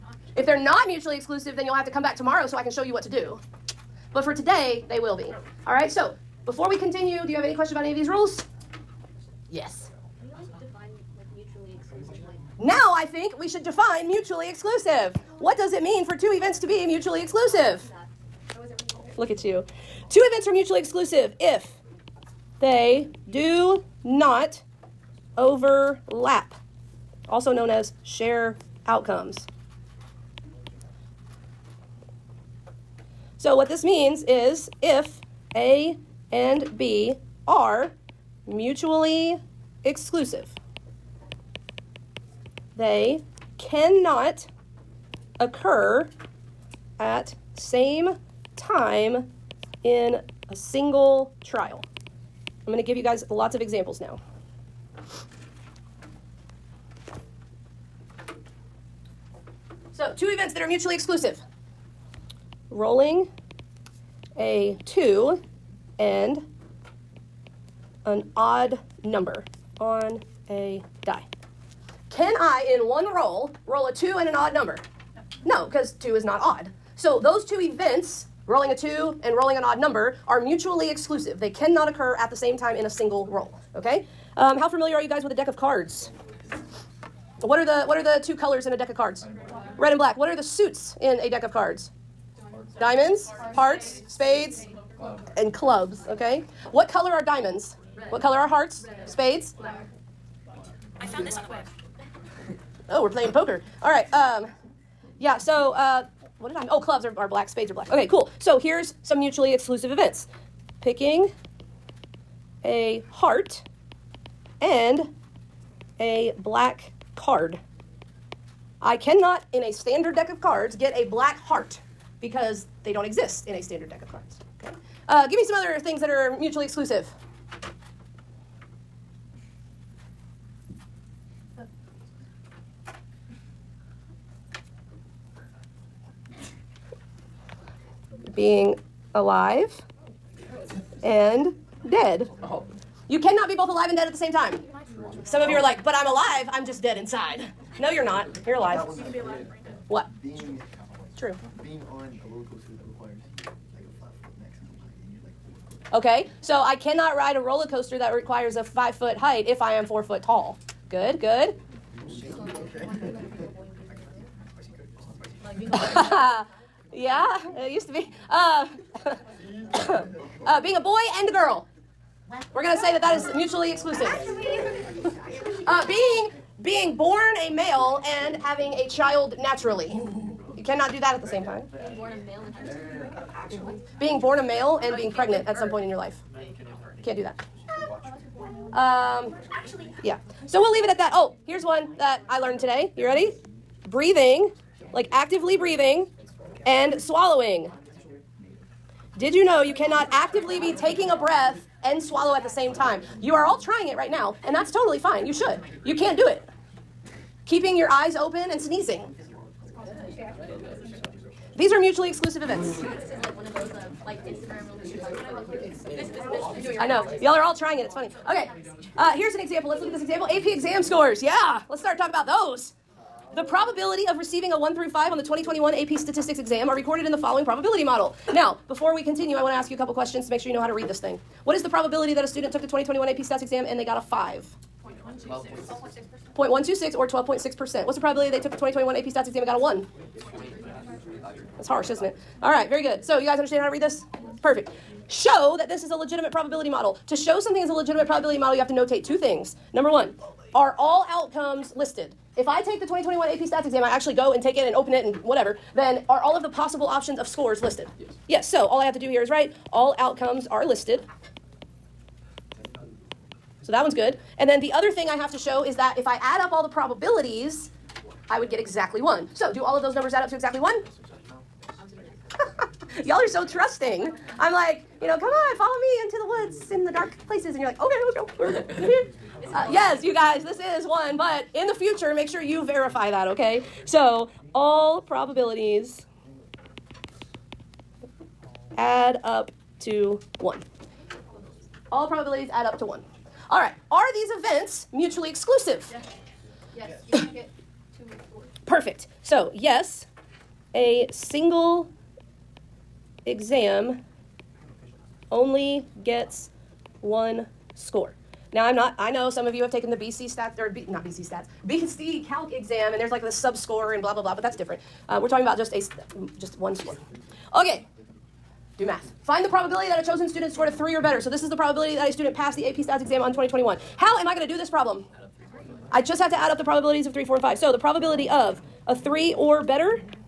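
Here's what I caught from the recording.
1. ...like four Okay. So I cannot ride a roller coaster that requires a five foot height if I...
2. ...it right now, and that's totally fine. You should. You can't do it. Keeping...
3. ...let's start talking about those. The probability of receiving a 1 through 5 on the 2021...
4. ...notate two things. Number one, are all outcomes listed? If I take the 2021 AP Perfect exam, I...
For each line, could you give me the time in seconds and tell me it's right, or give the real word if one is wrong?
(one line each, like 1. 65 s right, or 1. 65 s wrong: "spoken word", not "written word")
1. 155 s right
2. 203 s right
3. 221 s right
4. 248 s wrong: "Stats", not "Perfect".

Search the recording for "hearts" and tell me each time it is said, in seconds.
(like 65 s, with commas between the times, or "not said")
93 s, 98 s, 113 s, 121 s.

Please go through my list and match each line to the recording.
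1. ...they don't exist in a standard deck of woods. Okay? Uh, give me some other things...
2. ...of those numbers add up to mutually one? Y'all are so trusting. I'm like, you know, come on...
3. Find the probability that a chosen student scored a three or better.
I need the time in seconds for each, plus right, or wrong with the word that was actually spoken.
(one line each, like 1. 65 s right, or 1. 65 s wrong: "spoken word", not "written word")
1. 122 s wrong: "cards", not "woods"
2. 269 s wrong: "exactly", not "mutually"
3. 319 s right.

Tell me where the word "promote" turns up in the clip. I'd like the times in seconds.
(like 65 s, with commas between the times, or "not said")
not said.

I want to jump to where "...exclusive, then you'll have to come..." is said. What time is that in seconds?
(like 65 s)
1 s.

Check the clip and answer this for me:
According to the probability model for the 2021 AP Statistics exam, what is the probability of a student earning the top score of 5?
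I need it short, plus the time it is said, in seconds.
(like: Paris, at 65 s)
0.126, at 236 s.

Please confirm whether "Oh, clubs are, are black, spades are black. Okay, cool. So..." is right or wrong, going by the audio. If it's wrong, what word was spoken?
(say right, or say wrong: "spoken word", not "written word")
right.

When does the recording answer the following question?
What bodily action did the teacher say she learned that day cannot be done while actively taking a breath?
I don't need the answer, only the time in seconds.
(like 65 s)
197 s.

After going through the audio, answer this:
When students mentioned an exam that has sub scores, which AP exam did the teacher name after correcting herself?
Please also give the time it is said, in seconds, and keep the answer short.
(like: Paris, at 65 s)
BC Calc, at 311 s.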